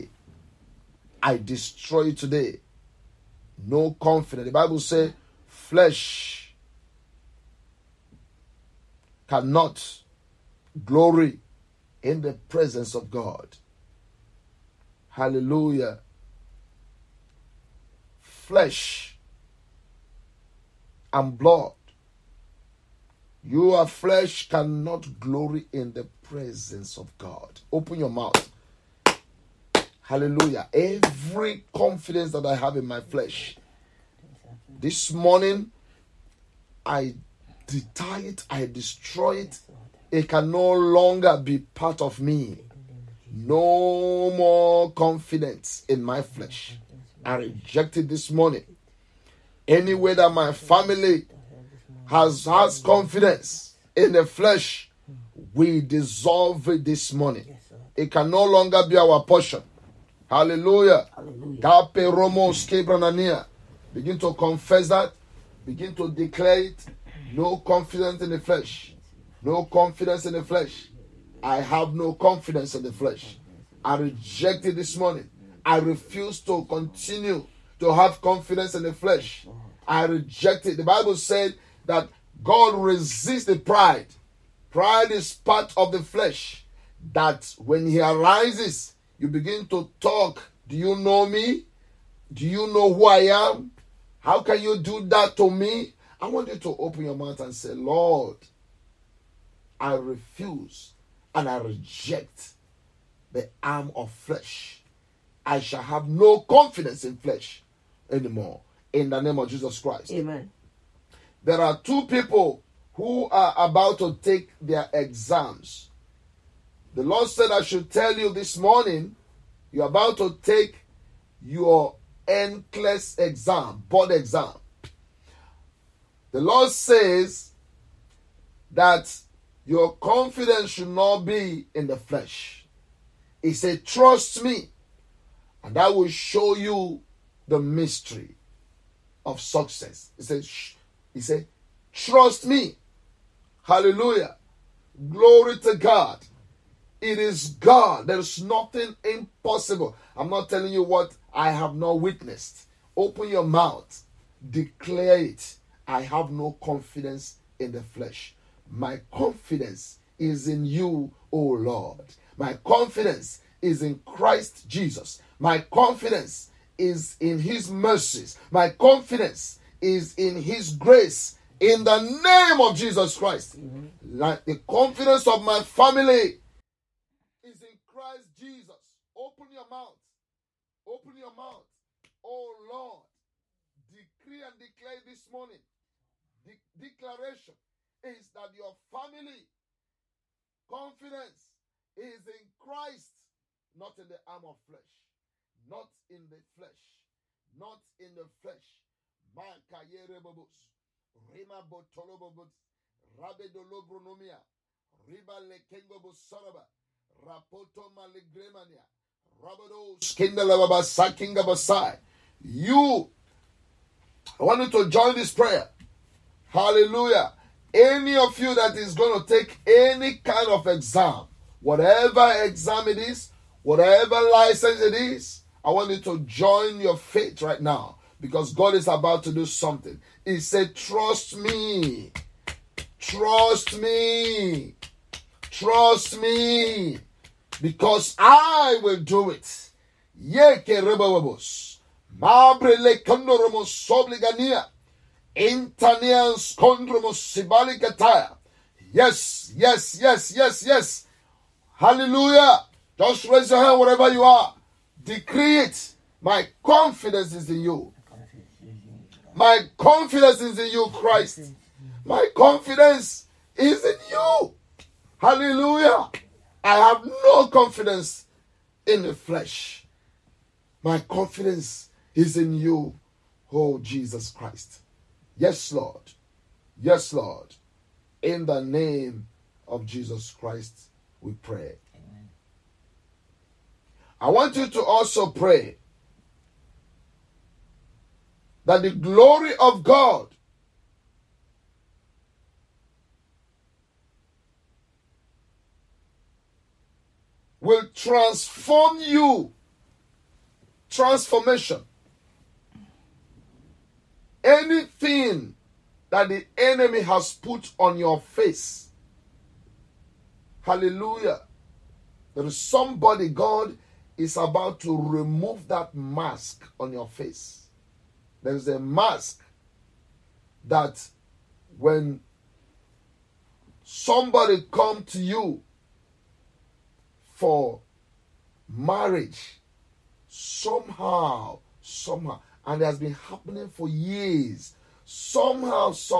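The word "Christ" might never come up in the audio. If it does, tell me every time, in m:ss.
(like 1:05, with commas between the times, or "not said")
1:49, 2:44, 2:53, 2:57, 3:12, 4:20, 4:34, 4:40.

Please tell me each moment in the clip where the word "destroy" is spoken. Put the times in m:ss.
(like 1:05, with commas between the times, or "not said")
0:01, 0:38.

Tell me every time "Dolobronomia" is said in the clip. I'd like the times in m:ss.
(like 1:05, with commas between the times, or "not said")
3:23.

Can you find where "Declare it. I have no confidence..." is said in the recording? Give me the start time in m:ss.
2:34.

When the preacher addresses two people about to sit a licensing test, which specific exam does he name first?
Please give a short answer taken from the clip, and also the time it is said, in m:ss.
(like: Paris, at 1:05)
NCLEX, at 2:02.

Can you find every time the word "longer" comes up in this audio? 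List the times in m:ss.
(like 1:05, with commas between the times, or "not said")
0:40, 0:58.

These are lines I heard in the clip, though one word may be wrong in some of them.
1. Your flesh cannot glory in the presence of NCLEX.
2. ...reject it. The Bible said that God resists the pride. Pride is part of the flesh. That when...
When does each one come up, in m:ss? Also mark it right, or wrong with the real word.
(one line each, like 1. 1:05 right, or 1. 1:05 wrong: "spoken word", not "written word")
1. 0:23 wrong: "God", not "NCLEX"
2. 1:20 right.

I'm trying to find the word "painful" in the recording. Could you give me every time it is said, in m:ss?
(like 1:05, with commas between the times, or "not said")
not said.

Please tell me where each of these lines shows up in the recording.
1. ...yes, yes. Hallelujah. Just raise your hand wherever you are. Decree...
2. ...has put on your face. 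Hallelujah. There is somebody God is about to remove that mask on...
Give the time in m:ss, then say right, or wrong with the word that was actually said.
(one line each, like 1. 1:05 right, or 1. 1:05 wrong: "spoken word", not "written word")
1. 4:10 right
2. 5:07 right.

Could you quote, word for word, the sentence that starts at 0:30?
Every confidence that I have in my flesh.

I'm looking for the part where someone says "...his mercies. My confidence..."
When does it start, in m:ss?
2:47.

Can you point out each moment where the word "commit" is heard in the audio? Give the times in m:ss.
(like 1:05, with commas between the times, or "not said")
not said.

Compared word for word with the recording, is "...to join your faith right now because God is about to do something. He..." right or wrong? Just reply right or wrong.
right.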